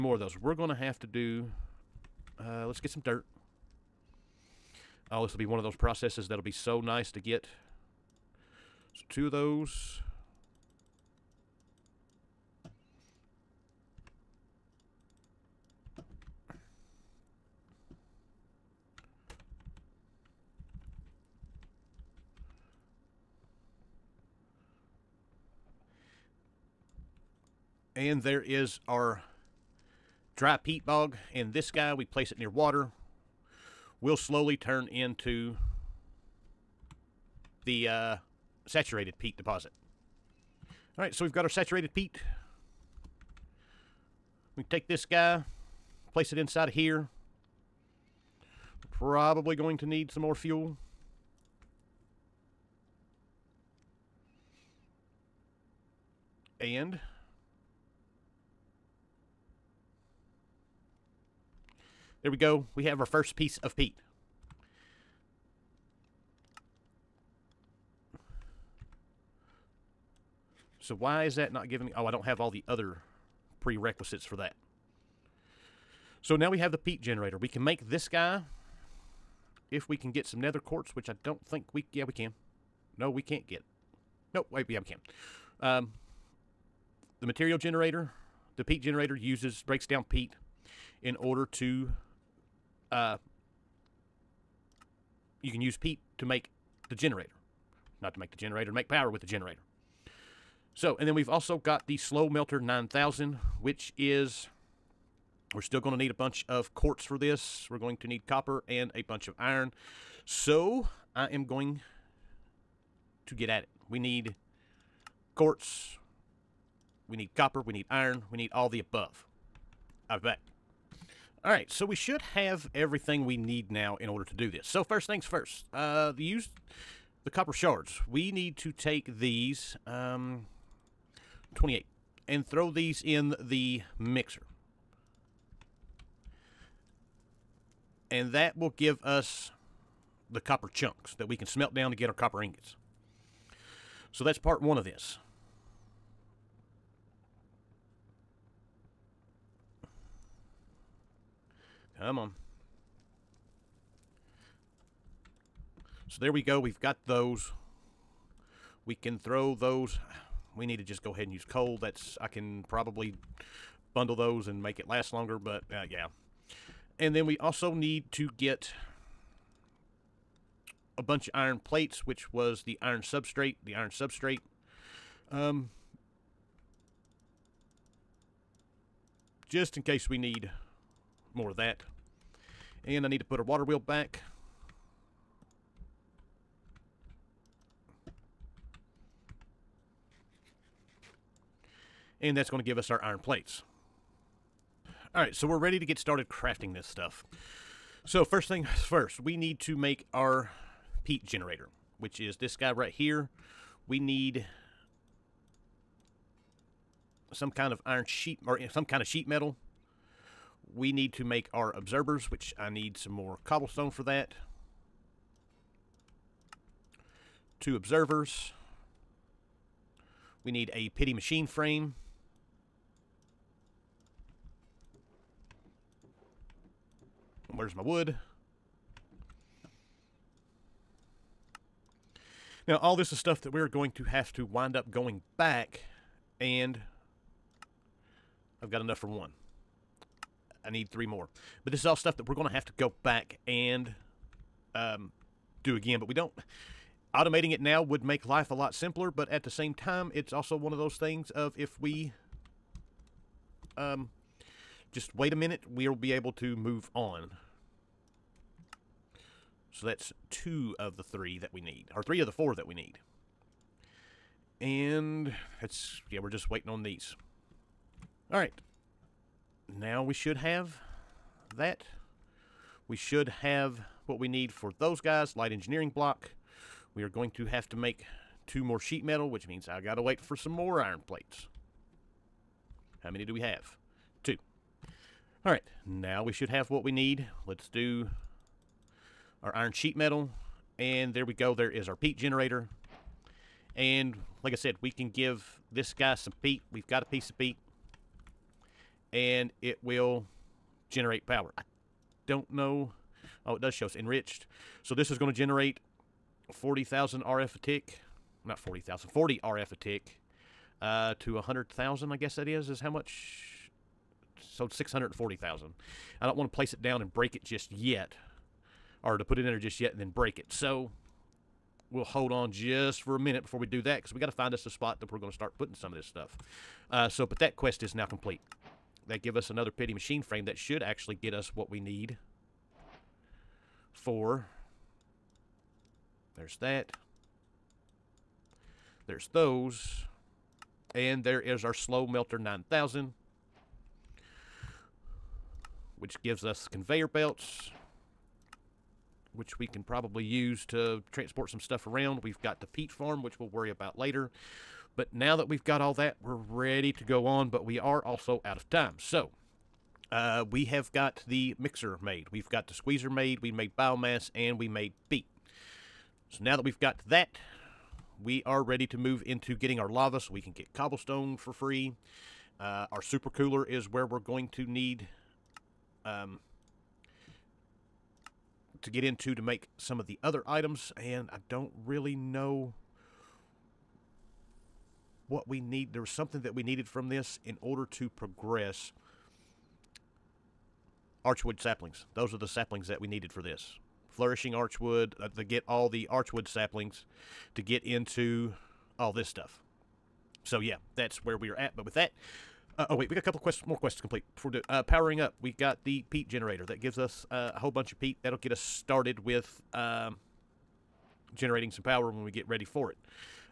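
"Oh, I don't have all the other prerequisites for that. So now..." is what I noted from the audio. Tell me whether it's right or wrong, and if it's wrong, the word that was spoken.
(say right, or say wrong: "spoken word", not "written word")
right.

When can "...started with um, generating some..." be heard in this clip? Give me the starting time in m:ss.
6:48.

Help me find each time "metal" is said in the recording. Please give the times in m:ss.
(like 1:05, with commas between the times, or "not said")
3:29, 4:39, 4:49.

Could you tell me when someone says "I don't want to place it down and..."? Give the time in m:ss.
5:16.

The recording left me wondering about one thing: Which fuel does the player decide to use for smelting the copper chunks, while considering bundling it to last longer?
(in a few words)
Coal.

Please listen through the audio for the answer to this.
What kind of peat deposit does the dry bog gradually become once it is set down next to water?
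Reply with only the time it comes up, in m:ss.
0:38.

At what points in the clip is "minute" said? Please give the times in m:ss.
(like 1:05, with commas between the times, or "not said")
4:15, 5:23.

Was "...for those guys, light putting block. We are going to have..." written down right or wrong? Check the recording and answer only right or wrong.
wrong.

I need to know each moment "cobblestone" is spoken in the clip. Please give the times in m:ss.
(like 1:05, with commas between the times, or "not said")
3:33, 6:10.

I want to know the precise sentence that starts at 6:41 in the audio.
But with that, uh, oh wait, we got a couple quests, more quests to complete before the, uh, powering up.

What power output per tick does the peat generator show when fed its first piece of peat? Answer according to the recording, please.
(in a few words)
40 RF.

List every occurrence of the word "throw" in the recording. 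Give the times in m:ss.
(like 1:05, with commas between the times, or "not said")
2:12, 2:39.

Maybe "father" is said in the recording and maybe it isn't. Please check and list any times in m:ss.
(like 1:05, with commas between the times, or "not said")
not said.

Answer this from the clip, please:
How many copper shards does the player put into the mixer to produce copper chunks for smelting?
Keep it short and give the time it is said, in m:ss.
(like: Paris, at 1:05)
28, at 2:11.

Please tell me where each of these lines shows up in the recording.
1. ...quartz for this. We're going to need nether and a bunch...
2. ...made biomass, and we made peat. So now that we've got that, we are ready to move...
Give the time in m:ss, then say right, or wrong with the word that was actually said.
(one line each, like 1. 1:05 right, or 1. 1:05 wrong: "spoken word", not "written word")
1. 1:46 wrong: "copper", not "nether"
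2. 6:03 right.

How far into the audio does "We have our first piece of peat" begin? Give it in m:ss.
1:02.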